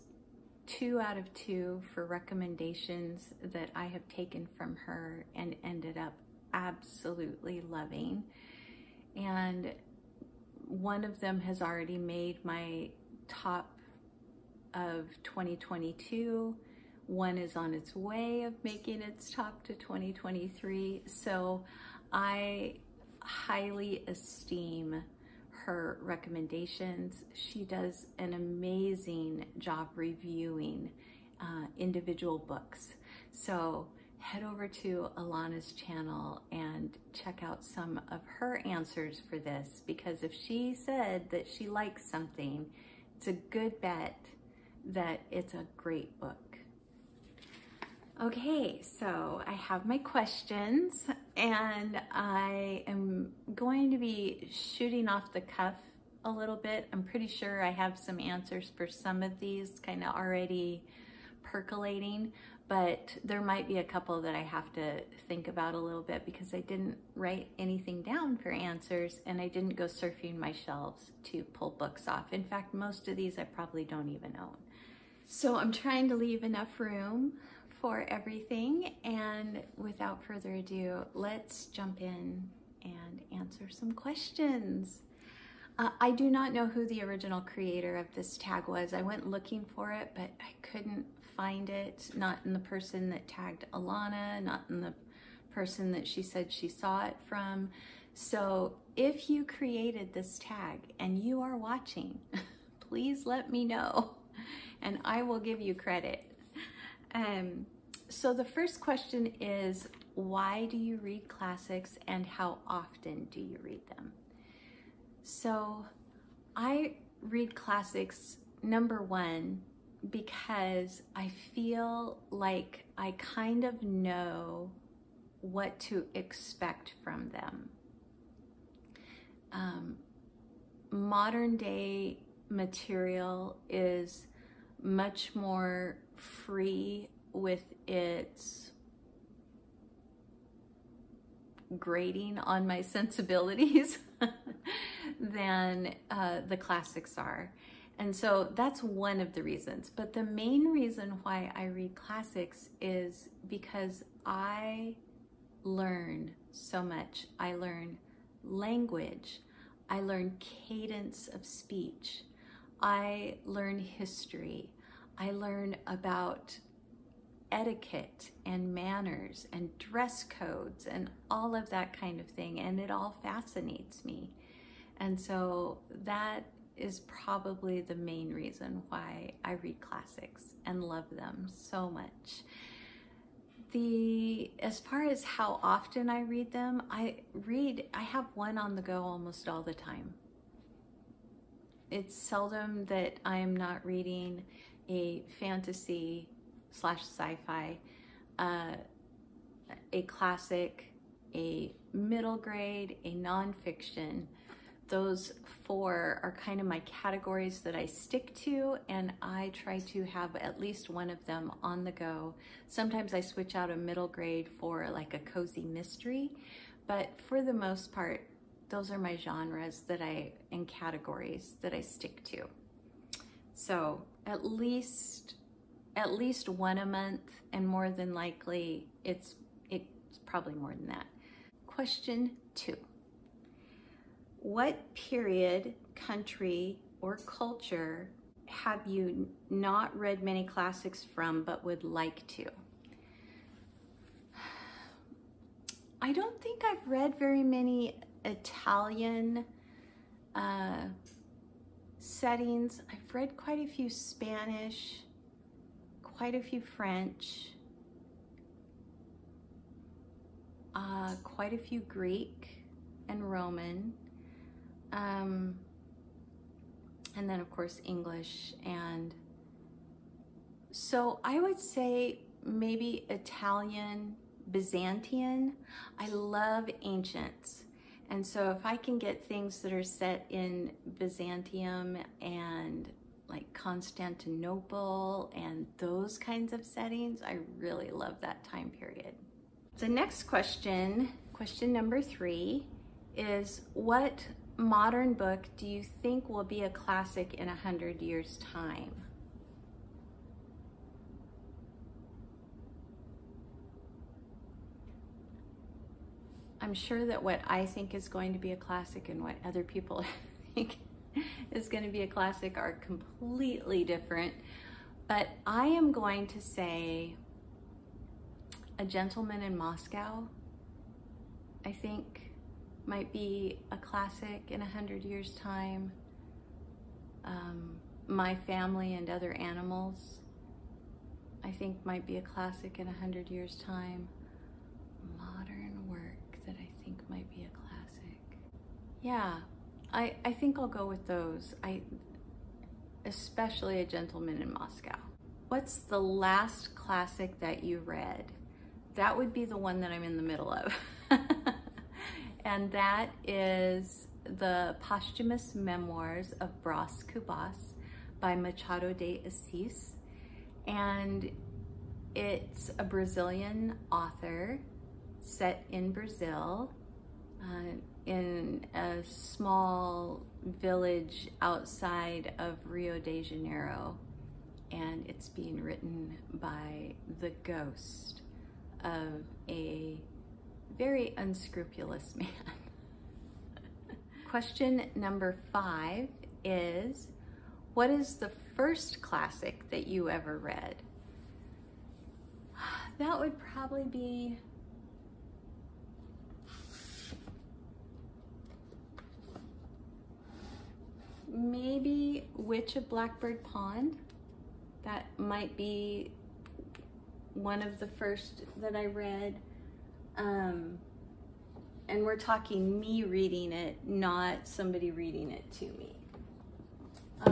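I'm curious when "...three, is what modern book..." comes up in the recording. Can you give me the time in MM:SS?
04:52.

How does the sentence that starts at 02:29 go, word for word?
But the main reason why I read classics is because I learn so much.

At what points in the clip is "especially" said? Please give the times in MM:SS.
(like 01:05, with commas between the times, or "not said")
05:43.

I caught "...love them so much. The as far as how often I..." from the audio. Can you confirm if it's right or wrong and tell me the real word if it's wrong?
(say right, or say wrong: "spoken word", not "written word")
right.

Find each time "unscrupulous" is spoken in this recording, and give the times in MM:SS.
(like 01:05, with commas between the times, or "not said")
06:21.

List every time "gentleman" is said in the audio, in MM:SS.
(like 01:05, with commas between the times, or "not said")
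05:18, 05:43.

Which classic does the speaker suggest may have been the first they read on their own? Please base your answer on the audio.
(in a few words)
Witch of Blackbird Pond.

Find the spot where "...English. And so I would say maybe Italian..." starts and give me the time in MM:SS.
04:27.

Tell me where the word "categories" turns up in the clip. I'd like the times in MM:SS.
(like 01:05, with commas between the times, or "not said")
03:26, 03:40.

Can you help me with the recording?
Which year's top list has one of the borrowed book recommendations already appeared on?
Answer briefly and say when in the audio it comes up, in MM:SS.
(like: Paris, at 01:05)
2022, at 00:15.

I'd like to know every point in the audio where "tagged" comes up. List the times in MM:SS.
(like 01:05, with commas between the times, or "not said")
01:33.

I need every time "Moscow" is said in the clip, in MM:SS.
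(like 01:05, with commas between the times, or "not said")
05:19, 05:44.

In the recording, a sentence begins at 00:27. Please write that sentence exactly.
She does an amazing job reviewing uh, individual books.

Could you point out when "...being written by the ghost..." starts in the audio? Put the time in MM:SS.
06:15.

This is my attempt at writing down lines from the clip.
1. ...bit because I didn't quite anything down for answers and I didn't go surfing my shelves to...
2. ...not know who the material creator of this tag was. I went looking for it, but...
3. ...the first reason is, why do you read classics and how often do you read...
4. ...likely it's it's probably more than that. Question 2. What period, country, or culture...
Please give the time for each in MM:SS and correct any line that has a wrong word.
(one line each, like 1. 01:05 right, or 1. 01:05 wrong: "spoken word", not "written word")
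1. 01:06 wrong: "write", not "quite"
2. 01:26 wrong: "original", not "material"
3. 01:48 wrong: "question", not "reason"
4. 03:48 right.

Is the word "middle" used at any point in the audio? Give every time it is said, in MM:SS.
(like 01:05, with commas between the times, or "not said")
03:21, 03:33, 05:50.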